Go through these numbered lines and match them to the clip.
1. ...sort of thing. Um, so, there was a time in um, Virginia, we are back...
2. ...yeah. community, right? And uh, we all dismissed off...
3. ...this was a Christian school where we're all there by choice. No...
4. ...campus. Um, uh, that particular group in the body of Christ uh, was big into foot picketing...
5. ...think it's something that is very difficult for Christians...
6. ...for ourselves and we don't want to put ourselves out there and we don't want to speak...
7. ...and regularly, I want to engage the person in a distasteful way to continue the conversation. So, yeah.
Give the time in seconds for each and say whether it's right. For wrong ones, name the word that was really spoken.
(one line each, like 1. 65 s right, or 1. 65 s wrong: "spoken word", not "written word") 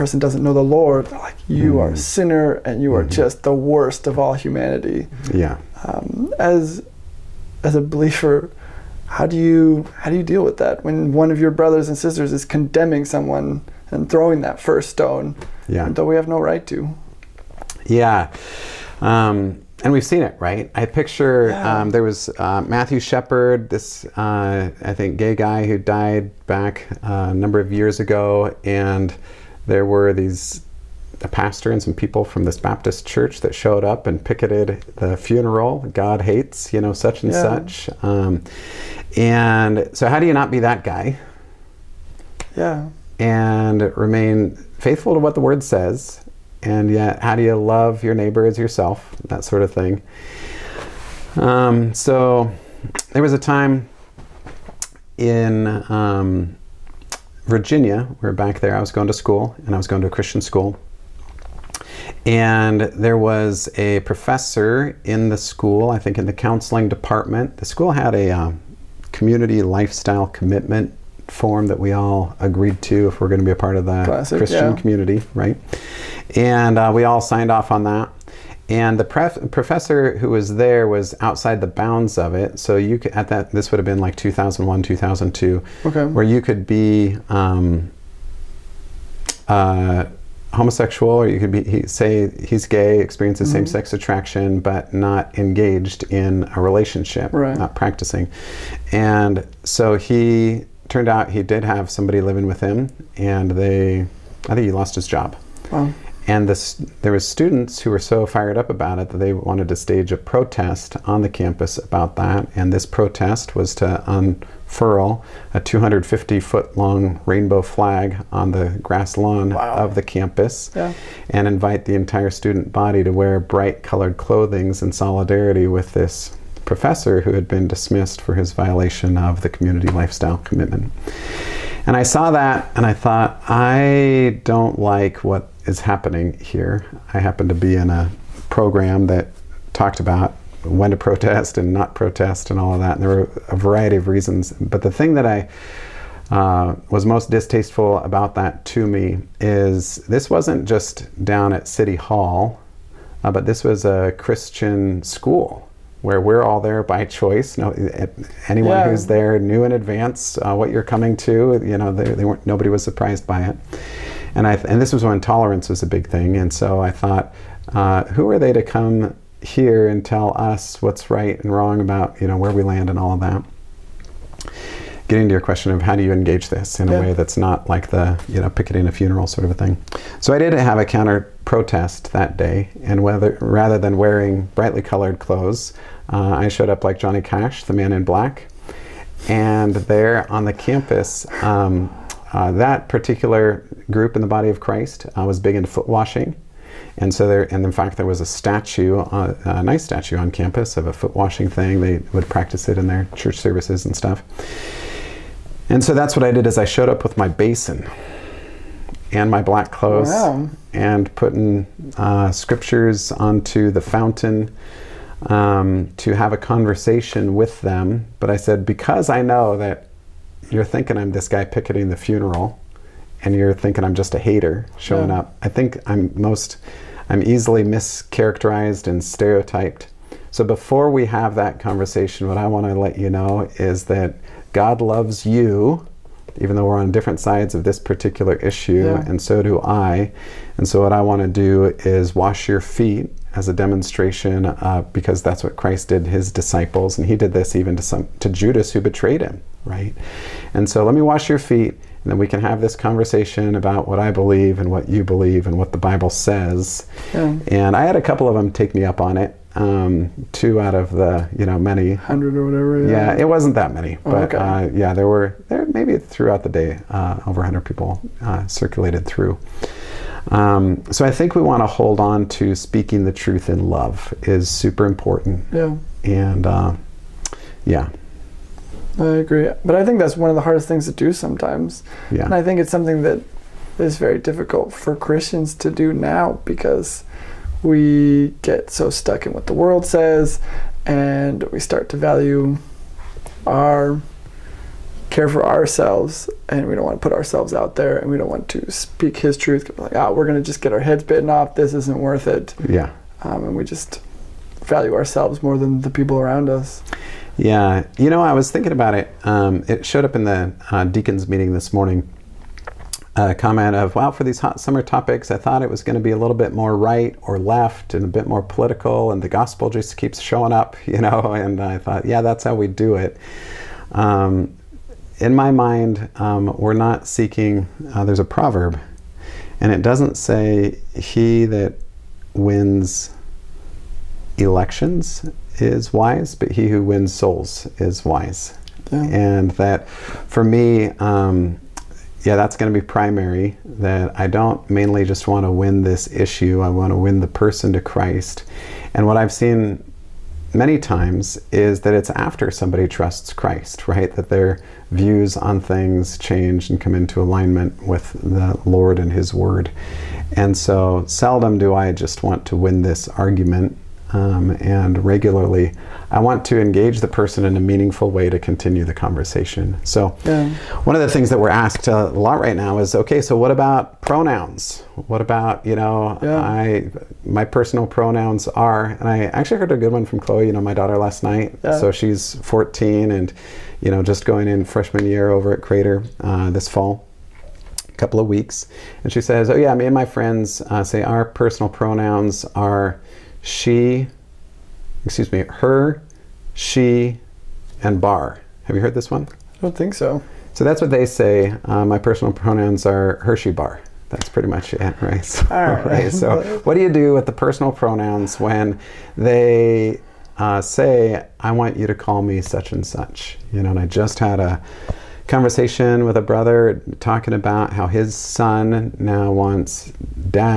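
1. 49 s right
2. 74 s wrong: "signed", not "dismissed"
3. 153 s right
4. 190 s wrong: "washing", not "picketing"
5. 282 s right
6. 295 s right
7. 364 s wrong: "meaningful", not "distasteful".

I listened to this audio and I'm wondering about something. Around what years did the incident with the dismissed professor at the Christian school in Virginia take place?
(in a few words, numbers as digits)
2001, 2002.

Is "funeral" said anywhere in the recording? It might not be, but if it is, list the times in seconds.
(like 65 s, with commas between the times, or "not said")
35 s, 178 s, 221 s.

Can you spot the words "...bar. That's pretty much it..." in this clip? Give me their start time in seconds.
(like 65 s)
403 s.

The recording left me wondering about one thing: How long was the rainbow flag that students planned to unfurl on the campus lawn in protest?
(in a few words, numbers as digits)
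250 feet.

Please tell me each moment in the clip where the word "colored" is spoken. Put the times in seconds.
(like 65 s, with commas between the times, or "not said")
123 s, 184 s.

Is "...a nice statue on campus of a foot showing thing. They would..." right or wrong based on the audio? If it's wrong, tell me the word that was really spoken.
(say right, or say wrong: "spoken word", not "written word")
wrong: "washing", not "showing".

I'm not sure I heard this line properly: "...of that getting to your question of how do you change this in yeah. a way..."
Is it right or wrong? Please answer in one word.
wrong.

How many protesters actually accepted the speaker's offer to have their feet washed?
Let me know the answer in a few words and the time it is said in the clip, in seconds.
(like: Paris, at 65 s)
2, at 260 s.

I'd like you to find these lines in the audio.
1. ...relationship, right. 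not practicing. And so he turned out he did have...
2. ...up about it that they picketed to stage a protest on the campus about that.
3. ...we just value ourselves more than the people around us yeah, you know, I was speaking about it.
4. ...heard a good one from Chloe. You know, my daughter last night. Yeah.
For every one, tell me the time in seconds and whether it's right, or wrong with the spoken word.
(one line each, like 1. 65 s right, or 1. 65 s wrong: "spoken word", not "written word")
1. 96 s right
2. 108 s wrong: "wanted", not "picketed"
3. 303 s wrong: "thinking", not "speaking"
4. 379 s right.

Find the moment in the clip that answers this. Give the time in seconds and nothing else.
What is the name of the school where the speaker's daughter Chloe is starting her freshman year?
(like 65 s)
385 s.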